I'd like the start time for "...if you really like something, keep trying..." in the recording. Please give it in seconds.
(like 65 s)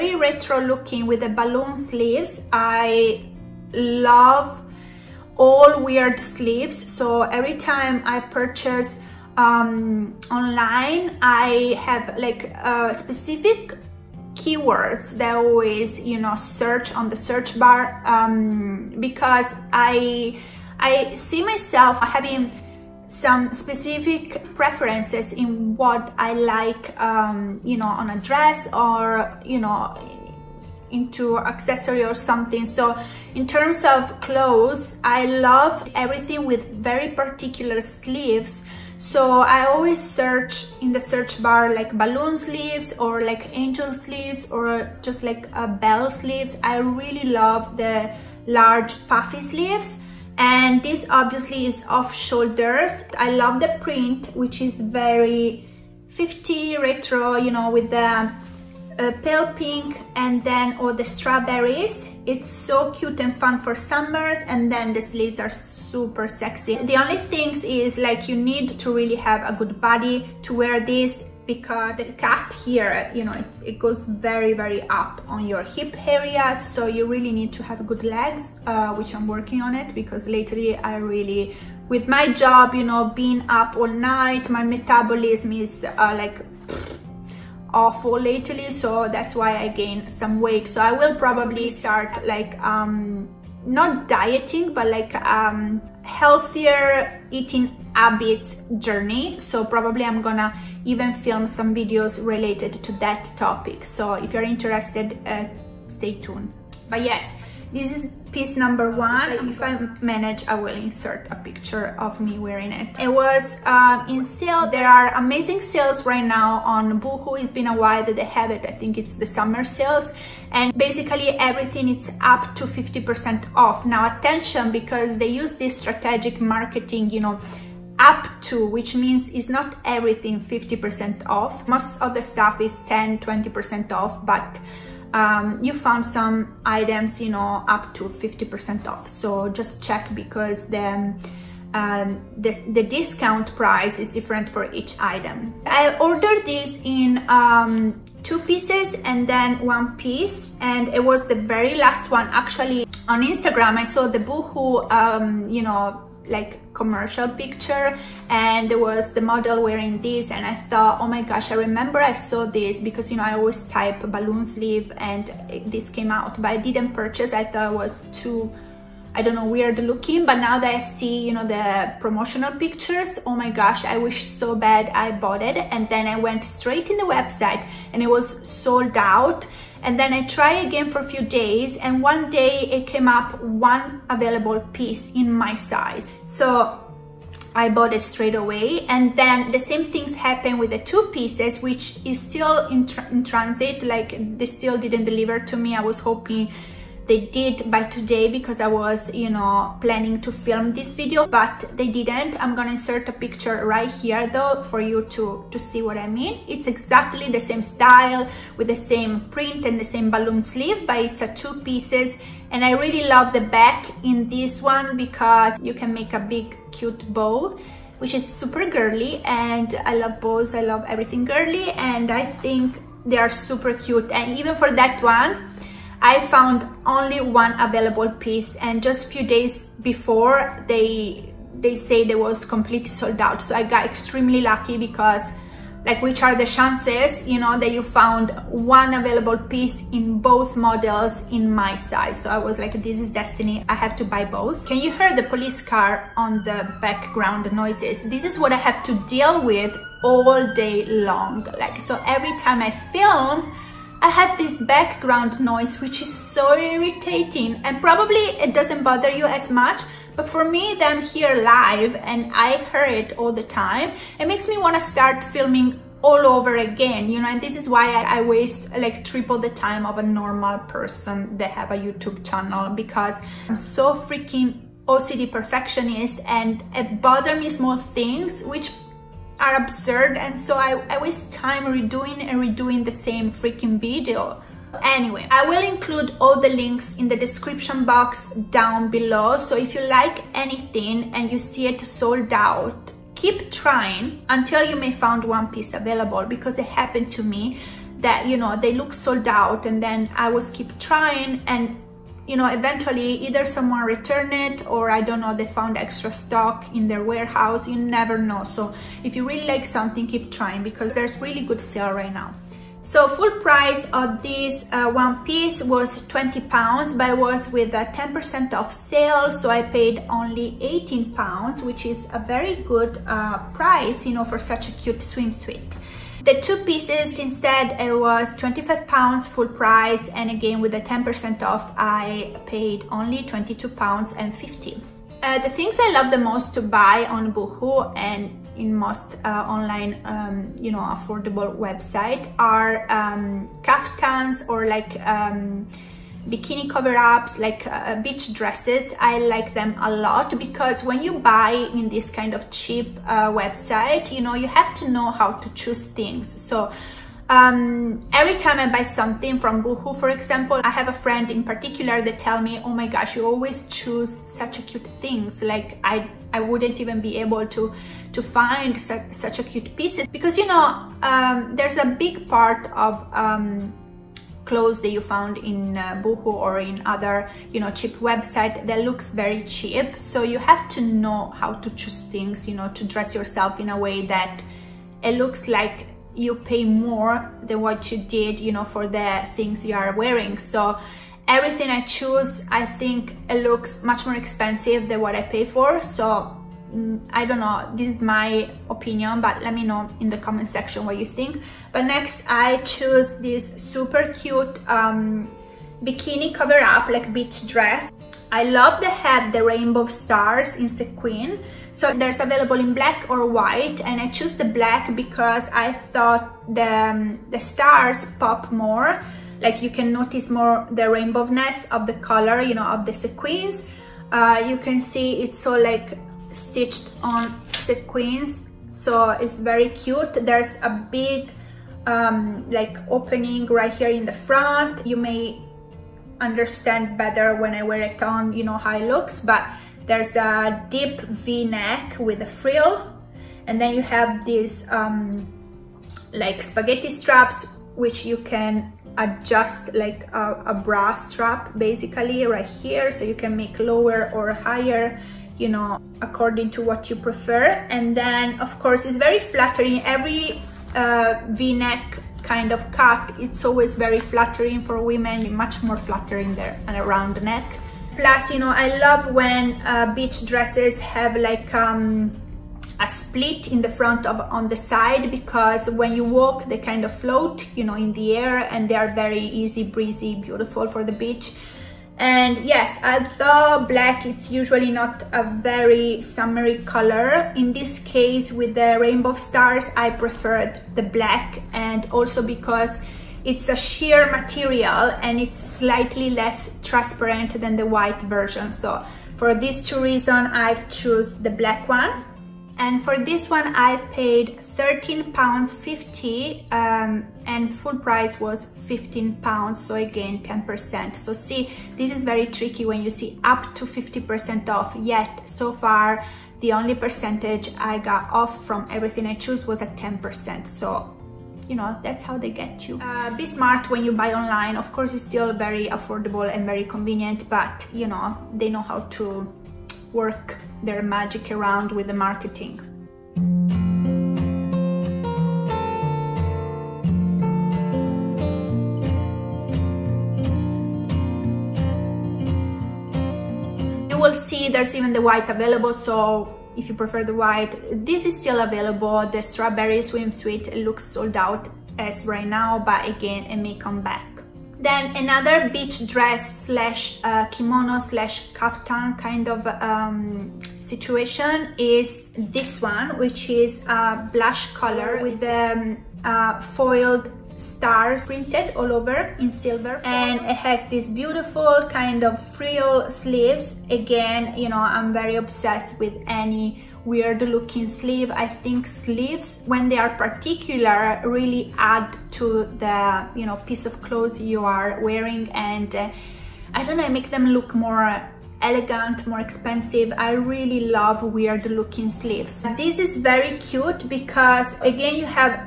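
309 s.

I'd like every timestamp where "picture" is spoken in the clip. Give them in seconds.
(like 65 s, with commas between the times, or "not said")
111 s, 157 s, 172 s, 203 s.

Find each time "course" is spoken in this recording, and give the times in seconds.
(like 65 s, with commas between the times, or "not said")
458 s, 524 s.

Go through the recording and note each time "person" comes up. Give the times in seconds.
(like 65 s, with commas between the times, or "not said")
270 s.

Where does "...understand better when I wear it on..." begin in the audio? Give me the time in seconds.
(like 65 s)
436 s.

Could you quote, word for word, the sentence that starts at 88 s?
So that's why I gained some weight.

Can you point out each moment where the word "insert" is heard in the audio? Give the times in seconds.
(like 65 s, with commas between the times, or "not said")
110 s, 202 s.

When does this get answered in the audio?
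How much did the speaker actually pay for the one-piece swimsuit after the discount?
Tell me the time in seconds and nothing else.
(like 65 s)
320 s.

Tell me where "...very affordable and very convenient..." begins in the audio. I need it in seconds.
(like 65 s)
525 s.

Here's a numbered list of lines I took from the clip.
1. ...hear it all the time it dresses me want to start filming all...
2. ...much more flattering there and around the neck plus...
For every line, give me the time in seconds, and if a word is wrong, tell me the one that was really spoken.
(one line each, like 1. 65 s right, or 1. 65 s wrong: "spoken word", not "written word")
1. 262 s wrong: "makes", not "dresses"
2. 465 s right.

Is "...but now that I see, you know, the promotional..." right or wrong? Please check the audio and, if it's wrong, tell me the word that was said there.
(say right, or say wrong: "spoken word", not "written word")
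right.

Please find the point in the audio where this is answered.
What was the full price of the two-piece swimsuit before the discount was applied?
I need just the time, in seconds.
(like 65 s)
328 s.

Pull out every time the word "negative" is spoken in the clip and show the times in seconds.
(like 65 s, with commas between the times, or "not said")
not said.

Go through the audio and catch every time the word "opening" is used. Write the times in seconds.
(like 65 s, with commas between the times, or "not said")
432 s.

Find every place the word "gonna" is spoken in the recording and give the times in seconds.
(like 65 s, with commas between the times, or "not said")
100 s, 202 s.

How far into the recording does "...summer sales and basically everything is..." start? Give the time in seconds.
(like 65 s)
119 s.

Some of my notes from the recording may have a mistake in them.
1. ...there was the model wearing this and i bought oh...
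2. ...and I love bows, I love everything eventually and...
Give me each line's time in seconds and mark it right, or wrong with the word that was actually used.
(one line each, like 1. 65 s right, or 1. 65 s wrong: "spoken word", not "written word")
1. 158 s wrong: "thought", not "bought"
2. 219 s wrong: "girly", not "eventually".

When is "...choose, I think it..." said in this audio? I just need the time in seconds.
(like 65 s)
391 s.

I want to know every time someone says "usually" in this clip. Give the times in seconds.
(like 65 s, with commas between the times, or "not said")
484 s.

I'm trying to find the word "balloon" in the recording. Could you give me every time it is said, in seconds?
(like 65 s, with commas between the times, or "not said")
1 s, 41 s, 164 s, 210 s.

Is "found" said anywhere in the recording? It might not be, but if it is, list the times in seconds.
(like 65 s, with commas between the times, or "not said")
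135 s, 226 s, 237 s, 305 s, 374 s.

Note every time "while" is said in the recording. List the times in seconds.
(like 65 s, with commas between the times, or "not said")
117 s.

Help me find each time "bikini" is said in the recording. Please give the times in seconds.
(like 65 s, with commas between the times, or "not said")
346 s, 405 s.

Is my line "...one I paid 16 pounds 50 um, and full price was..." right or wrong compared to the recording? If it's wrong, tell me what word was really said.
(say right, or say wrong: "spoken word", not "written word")
wrong: "13", not "16".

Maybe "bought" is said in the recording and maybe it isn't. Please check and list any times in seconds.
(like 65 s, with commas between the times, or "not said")
175 s, 187 s.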